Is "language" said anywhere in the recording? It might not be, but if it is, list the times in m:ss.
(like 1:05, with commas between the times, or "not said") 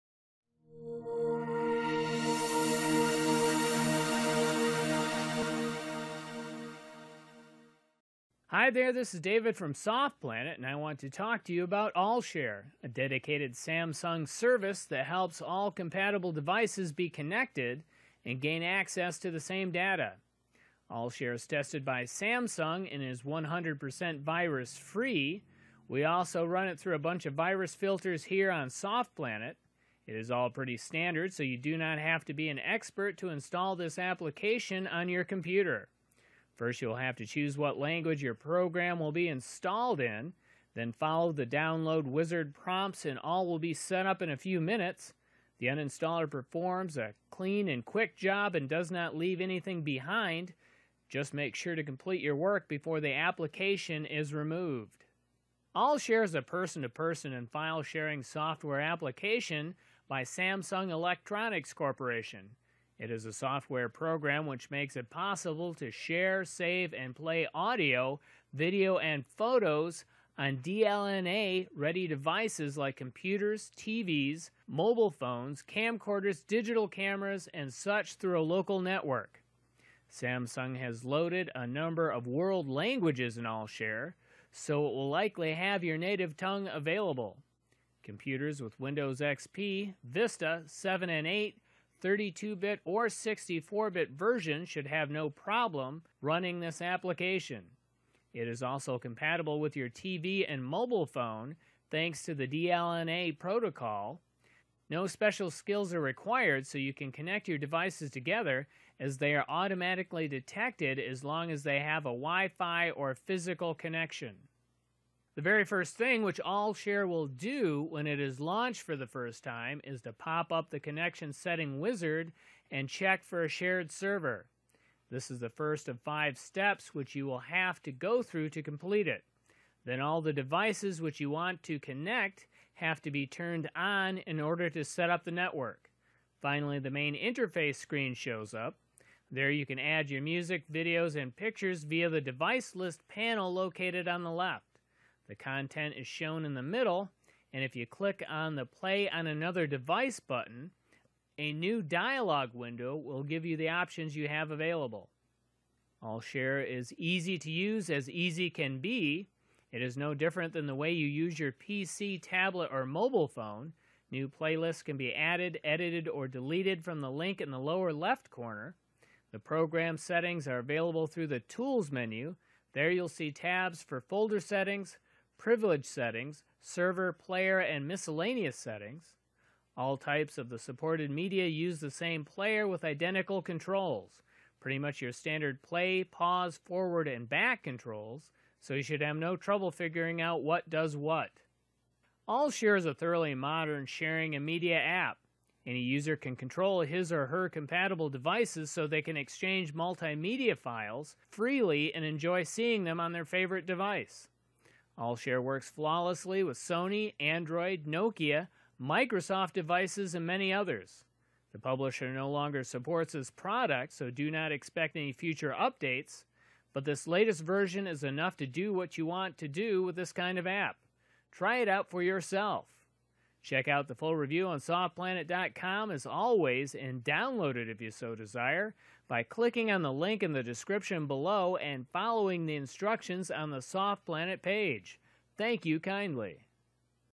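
0:37, 1:22.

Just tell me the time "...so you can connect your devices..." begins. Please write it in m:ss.
1:46.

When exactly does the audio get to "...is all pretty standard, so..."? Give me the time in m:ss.
0:30.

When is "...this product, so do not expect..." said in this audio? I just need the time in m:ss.
3:33.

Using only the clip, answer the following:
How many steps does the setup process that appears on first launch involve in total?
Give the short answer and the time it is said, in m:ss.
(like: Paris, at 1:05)
5, at 2:06.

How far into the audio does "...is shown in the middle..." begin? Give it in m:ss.
2:25.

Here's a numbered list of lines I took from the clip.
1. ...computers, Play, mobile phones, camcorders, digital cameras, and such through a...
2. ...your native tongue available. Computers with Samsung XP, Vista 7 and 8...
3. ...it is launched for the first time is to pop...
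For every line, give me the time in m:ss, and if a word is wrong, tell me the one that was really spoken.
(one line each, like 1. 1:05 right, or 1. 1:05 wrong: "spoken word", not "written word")
1. 1:12 wrong: "TVs", not "Play"
2. 1:25 wrong: "Windows", not "Samsung"
3. 1:58 right.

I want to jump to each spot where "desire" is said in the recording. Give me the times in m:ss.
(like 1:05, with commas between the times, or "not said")
3:48.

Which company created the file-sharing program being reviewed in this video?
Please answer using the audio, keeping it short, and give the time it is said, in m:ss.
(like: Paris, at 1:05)
Samsung Electronics Corporation, at 1:00.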